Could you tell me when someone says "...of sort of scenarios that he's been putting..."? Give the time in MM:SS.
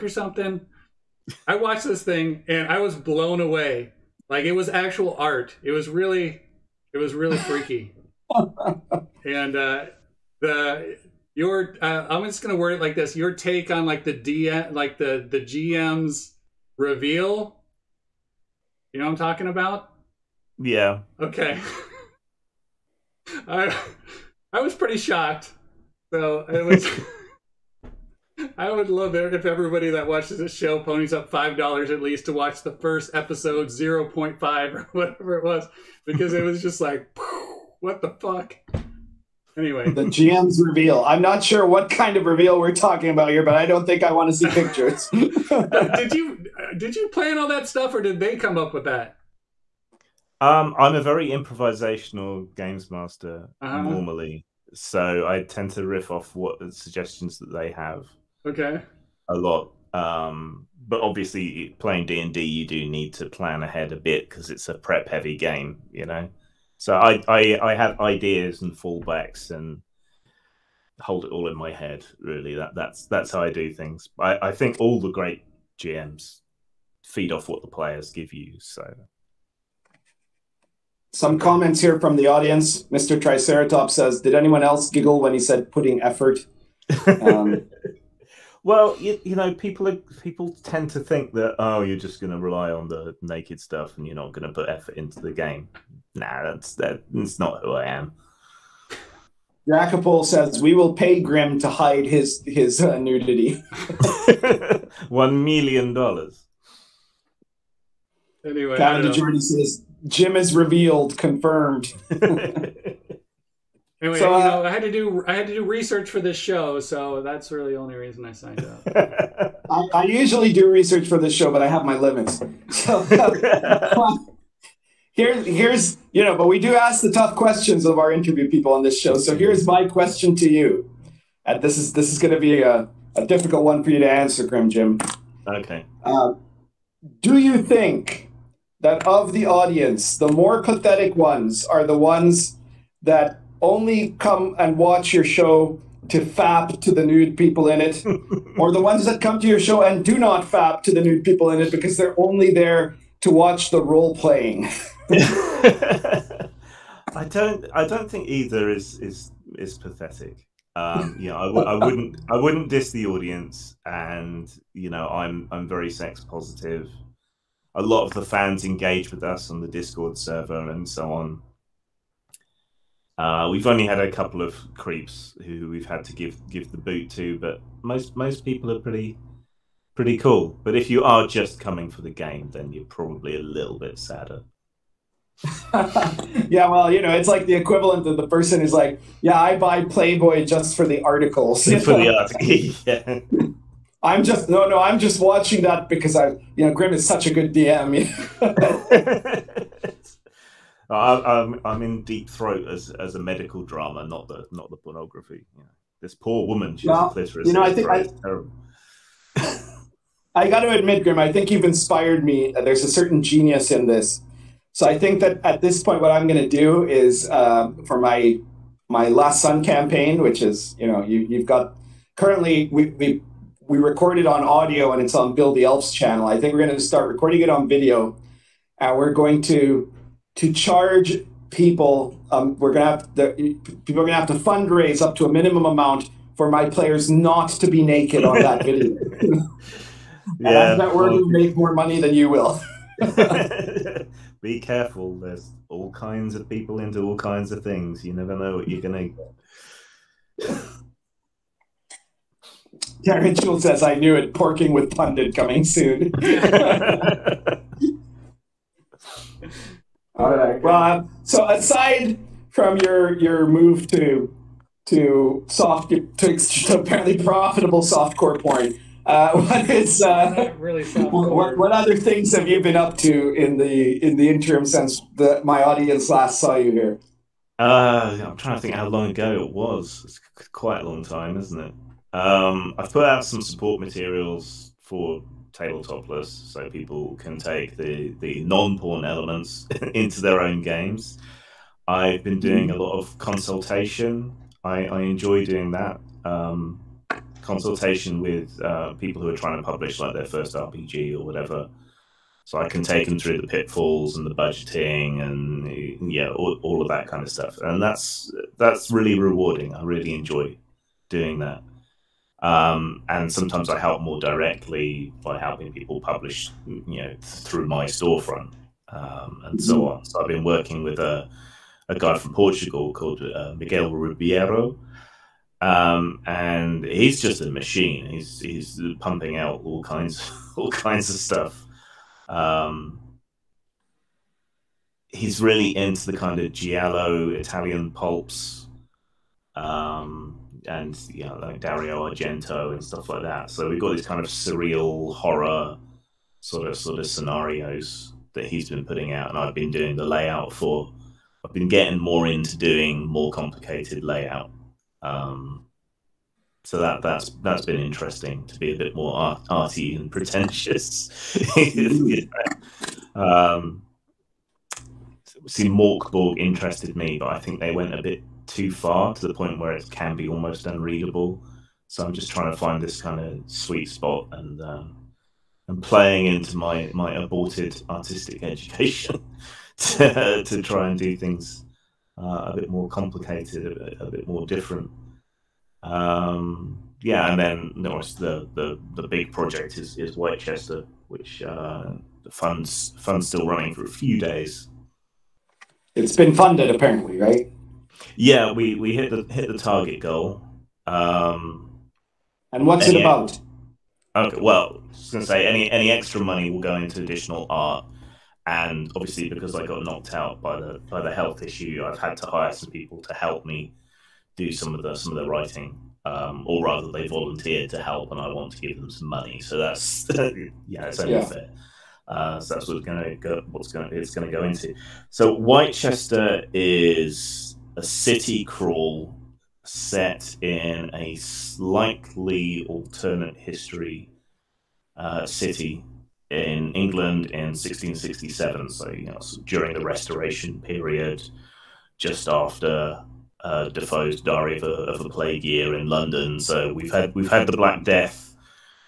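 05:46.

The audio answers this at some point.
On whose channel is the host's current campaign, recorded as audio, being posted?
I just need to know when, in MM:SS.
03:45.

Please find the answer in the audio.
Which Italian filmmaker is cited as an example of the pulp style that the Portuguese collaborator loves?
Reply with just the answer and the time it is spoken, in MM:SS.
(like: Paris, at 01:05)
Dario Argento, at 05:41.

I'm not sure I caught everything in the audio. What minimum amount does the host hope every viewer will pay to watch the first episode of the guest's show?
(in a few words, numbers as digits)
$5.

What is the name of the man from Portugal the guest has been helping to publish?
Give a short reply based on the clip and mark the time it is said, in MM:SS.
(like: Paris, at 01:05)
Miguel Ribeiro, at 05:23.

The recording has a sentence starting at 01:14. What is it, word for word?
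I, I think all the great GMs feed off what the players give you.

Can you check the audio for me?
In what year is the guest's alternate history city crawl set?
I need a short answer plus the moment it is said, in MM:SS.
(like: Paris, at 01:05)
1667, at 07:17.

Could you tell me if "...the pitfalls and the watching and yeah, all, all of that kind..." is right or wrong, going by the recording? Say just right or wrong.
wrong.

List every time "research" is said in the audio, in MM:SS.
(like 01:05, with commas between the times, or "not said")
01:55, 02:00.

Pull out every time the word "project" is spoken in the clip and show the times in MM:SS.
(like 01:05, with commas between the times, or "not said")
06:29.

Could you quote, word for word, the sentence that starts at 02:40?
Um, you iwi would not I w- I wouldn't.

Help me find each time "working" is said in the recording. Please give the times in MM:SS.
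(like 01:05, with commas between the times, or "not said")
05:20.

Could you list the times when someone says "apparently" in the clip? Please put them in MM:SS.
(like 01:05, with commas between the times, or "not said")
04:26, 06:36.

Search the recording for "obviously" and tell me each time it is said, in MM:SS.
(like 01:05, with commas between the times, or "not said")
01:00, 06:48.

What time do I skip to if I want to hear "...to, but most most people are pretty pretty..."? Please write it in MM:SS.
02:57.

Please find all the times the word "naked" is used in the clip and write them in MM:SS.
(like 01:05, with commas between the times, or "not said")
01:33, 03:57.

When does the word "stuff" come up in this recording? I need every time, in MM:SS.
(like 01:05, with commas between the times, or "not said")
00:47, 01:33, 05:07, 05:31, 05:42.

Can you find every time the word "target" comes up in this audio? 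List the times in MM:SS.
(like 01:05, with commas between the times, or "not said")
06:39.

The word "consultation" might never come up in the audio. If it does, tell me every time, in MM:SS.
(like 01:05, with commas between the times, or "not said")
04:53, 04:57.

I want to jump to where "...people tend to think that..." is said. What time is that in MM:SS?
01:29.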